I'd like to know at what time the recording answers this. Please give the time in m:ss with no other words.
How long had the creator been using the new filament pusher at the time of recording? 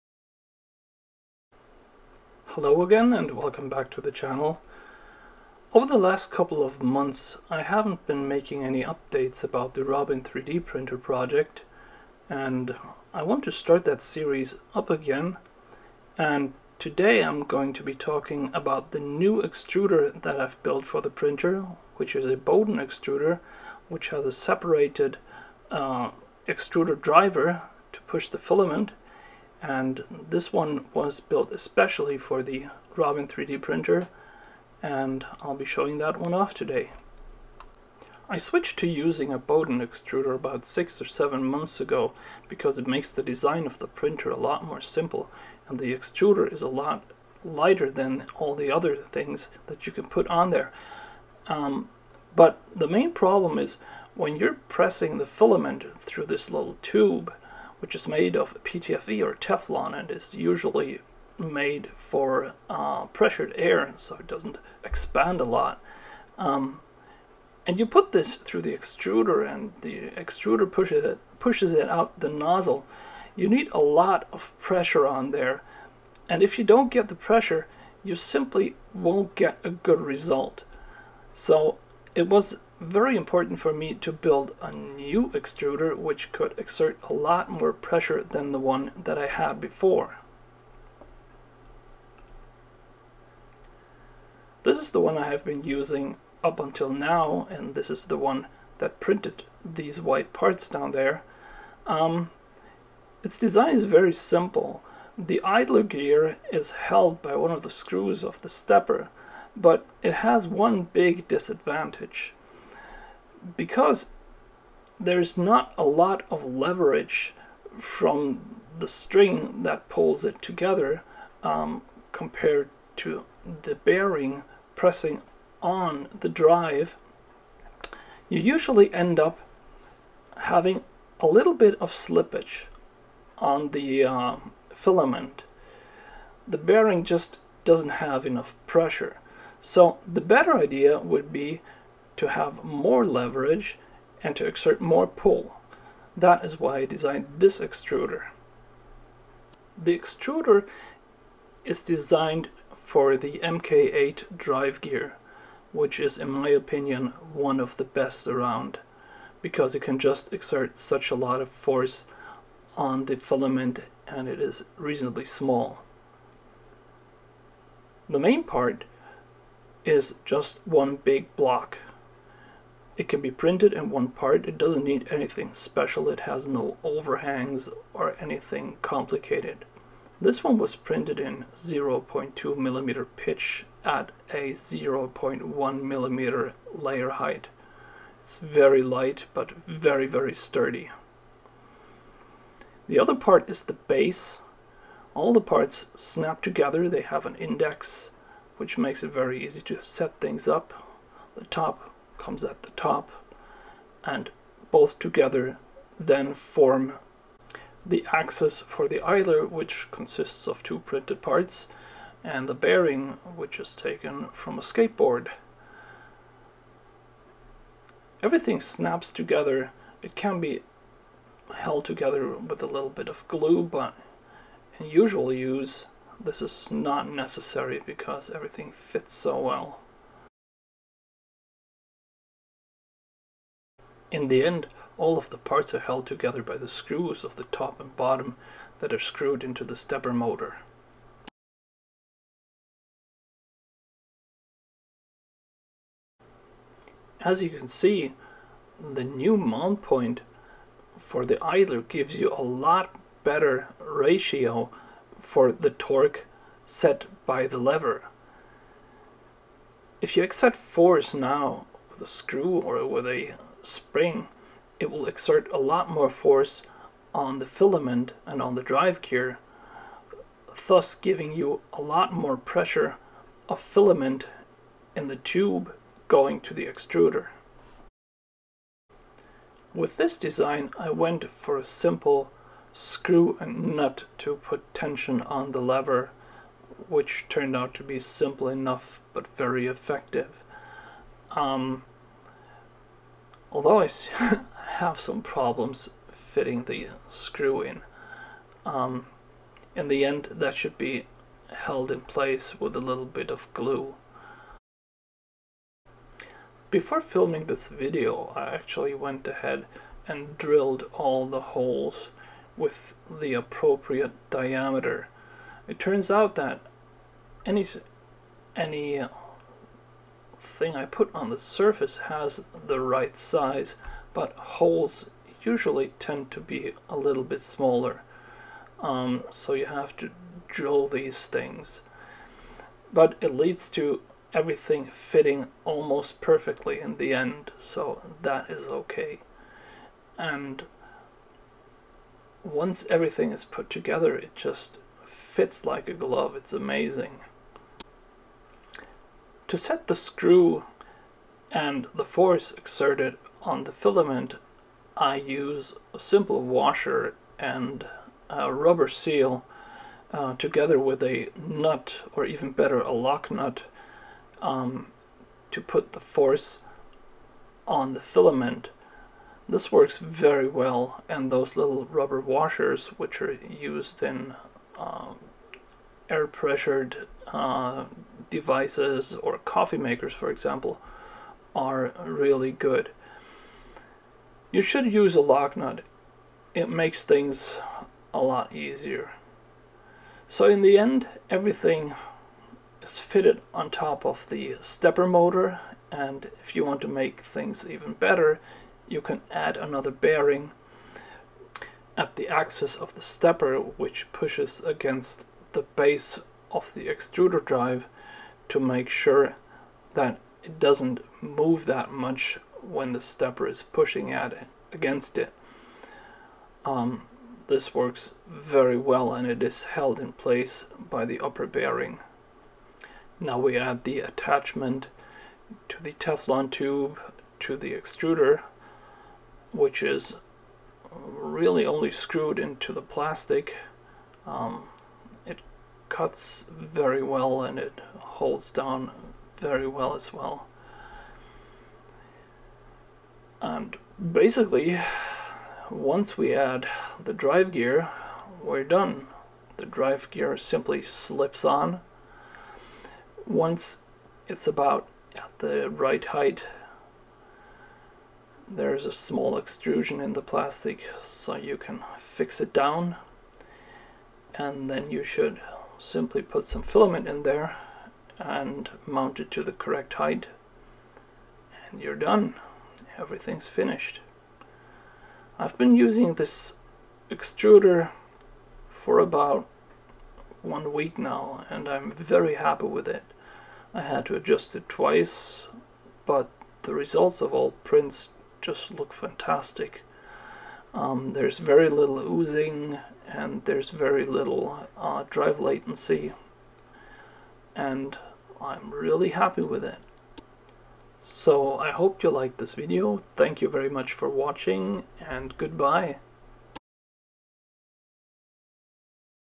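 7:58.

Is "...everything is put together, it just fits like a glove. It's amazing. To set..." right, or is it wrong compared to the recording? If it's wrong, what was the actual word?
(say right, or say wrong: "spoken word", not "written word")
right.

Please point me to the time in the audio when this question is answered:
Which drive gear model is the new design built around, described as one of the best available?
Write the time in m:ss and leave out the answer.
2:33.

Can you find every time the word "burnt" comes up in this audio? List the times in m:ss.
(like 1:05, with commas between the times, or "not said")
not said.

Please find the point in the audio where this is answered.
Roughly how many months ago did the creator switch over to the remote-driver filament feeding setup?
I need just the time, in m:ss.
0:40.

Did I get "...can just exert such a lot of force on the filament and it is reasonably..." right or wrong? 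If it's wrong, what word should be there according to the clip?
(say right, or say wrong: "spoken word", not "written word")
right.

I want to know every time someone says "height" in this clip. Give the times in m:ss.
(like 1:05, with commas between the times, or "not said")
3:07, 7:36, 7:49.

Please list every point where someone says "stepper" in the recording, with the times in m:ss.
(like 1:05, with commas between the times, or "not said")
1:48, 3:59, 6:34, 6:43, 6:53.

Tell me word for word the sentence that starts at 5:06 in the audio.
Before filming this video I actually went ahead and drilled all the holes with the appropriate diameter.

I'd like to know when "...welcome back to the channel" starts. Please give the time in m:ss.
0:03.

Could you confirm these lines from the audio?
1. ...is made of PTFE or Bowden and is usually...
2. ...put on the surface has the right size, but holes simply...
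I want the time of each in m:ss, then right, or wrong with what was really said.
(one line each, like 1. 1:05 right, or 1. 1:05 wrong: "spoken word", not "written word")
1. 0:57 wrong: "Teflon", not "Bowden"
2. 5:20 wrong: "usually", not "simply".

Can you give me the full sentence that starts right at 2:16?
The bearing just doesn't have enough pressure.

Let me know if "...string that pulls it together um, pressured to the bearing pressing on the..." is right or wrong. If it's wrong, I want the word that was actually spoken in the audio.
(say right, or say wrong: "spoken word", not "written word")
wrong: "compared", not "pressured".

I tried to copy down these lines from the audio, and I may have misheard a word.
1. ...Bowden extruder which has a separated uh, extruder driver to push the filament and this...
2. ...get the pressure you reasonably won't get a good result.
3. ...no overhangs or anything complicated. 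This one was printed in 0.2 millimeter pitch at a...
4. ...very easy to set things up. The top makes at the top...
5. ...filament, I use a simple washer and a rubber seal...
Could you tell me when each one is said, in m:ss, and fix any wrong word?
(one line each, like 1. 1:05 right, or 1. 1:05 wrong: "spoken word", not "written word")
1. 0:22 right
2. 1:16 wrong: "simply", not "reasonably"
3. 2:56 right
4. 3:19 wrong: "comes", not "makes"
5. 5:53 right.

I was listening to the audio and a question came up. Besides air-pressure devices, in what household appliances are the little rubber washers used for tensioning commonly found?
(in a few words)
Coffee makers.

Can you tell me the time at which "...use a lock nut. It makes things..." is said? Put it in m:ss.
6:24.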